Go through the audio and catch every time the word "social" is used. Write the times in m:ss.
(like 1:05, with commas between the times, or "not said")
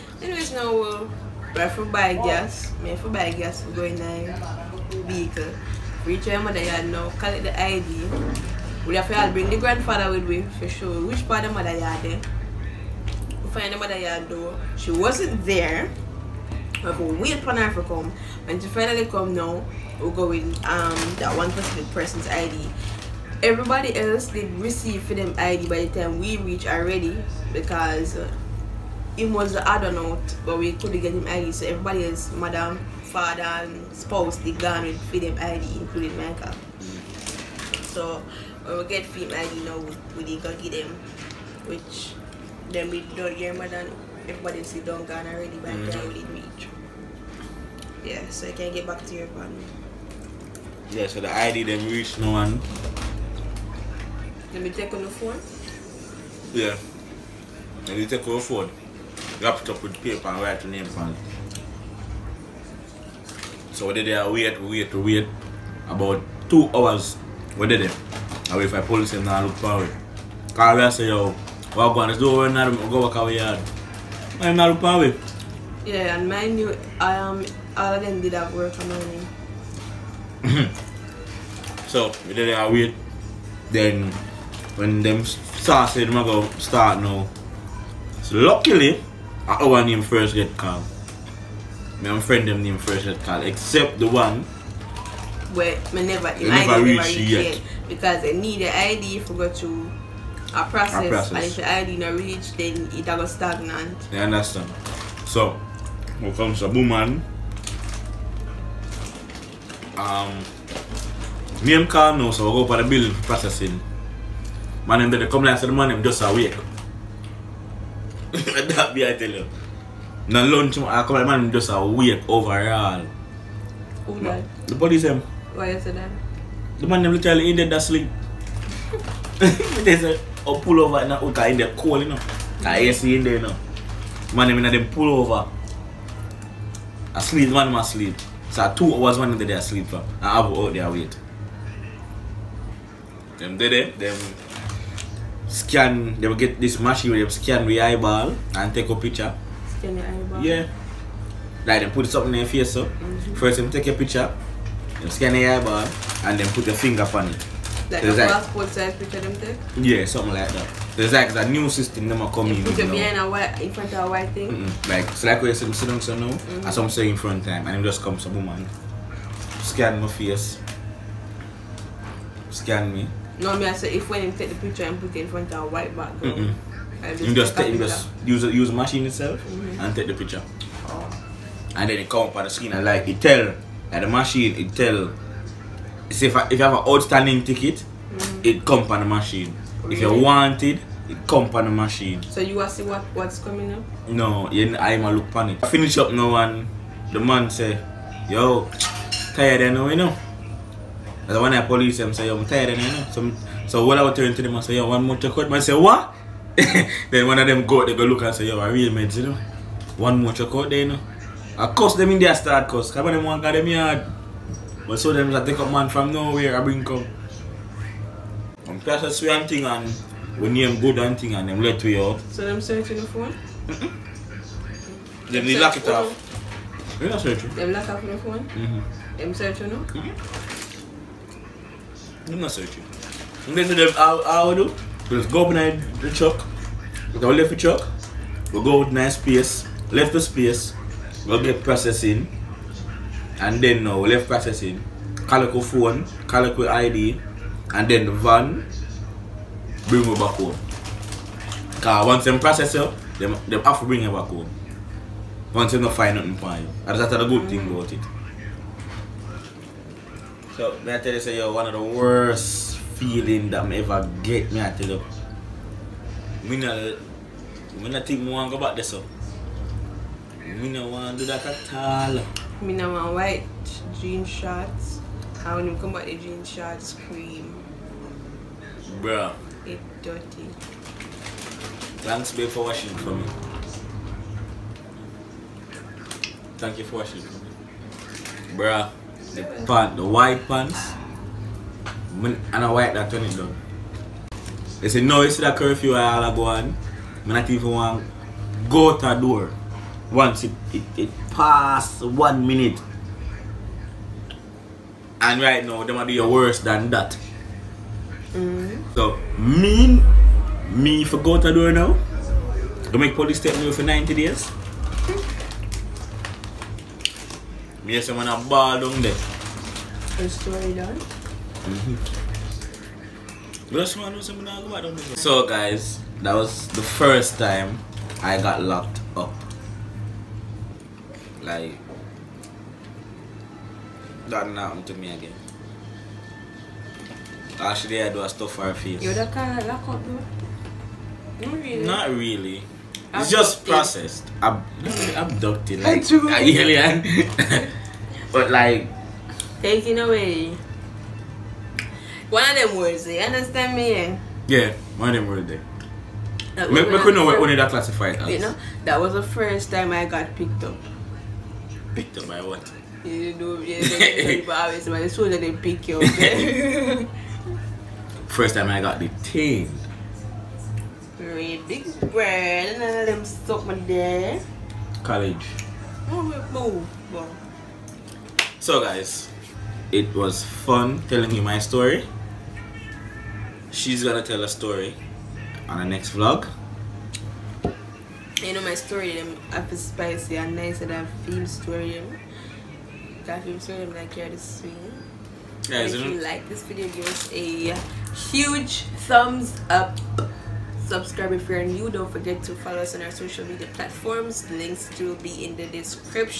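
6:43.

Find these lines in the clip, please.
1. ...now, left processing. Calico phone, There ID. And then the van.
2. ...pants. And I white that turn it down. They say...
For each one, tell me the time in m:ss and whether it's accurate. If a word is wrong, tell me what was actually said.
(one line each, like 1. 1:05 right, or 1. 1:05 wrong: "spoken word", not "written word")
1. 4:03 wrong: "Calico", not "There"
2. 4:50 right.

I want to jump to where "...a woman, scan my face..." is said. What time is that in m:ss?
2:48.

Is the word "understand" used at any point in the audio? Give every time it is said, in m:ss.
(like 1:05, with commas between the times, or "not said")
1:44, 5:53.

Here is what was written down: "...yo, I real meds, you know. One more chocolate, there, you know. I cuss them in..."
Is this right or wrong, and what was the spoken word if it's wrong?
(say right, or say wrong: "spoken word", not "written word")
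right.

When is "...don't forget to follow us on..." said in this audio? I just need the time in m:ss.
6:41.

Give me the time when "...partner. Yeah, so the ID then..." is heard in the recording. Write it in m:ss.
0:49.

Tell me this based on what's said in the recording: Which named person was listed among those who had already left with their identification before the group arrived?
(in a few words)
Michael.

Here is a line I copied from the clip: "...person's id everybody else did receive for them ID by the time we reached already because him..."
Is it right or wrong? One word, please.
right.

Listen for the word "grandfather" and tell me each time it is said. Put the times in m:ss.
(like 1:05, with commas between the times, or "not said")
0:09.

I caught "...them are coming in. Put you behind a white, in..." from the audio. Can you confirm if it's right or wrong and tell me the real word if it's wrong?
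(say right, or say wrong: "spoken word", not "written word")
right.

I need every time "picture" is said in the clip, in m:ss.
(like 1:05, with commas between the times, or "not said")
2:28, 2:33, 2:38, 2:54, 3:00.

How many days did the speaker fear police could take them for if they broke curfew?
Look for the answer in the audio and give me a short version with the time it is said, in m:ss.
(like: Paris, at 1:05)
90, at 5:13.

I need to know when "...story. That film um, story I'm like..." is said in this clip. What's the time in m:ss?
6:31.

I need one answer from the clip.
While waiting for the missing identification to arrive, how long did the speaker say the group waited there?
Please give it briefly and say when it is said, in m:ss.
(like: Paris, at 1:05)
2 hours, at 1:05.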